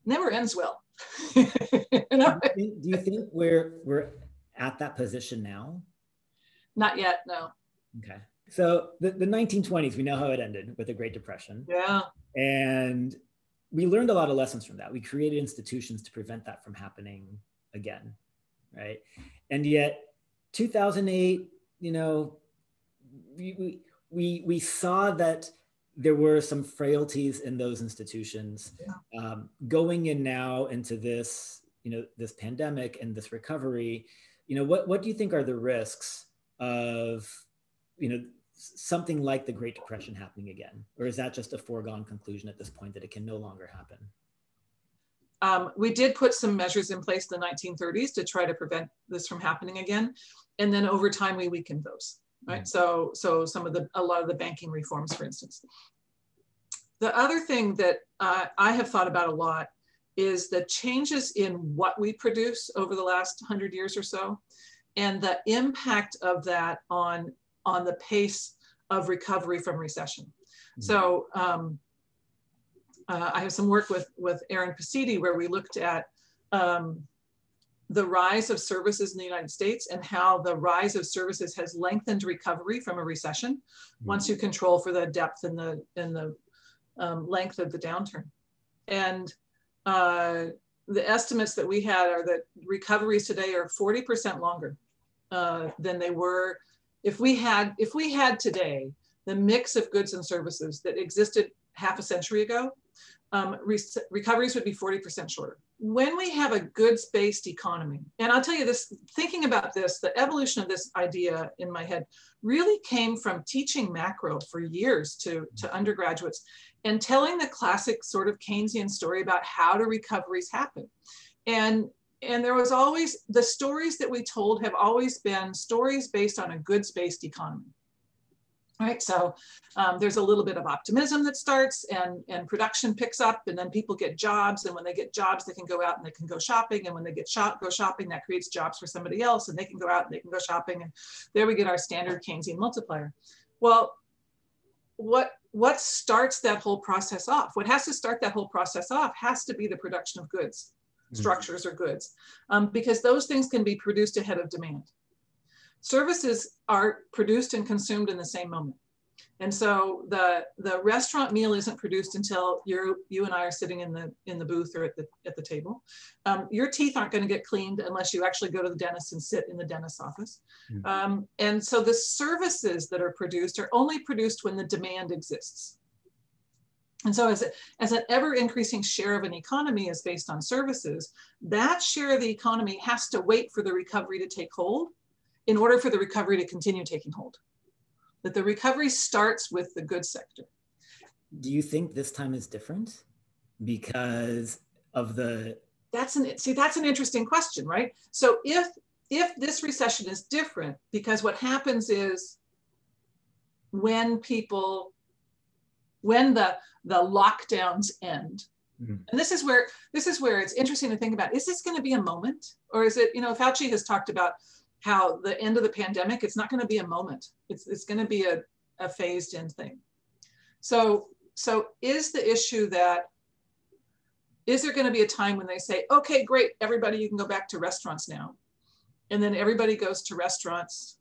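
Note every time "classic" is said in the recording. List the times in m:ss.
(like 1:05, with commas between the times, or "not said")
1:57.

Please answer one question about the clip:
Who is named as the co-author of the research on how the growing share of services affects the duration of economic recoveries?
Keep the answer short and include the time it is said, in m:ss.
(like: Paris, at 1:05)
Aaron Pacitti, at 1:14.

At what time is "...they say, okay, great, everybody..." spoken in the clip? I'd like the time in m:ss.
3:45.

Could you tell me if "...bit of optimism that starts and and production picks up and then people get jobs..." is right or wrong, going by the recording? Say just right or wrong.
right.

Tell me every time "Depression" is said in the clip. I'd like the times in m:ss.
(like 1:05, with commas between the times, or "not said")
0:11, 0:39.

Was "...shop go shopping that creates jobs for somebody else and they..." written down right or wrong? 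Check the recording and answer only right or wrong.
right.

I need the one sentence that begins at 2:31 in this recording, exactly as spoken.
structures or goods, um, because those things can be produced ahead of demand.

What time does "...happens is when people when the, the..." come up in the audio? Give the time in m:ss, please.
3:21.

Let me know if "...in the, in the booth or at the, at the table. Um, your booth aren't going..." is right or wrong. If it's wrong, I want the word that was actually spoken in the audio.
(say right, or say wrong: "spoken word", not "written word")
wrong: "teeth", not "booth".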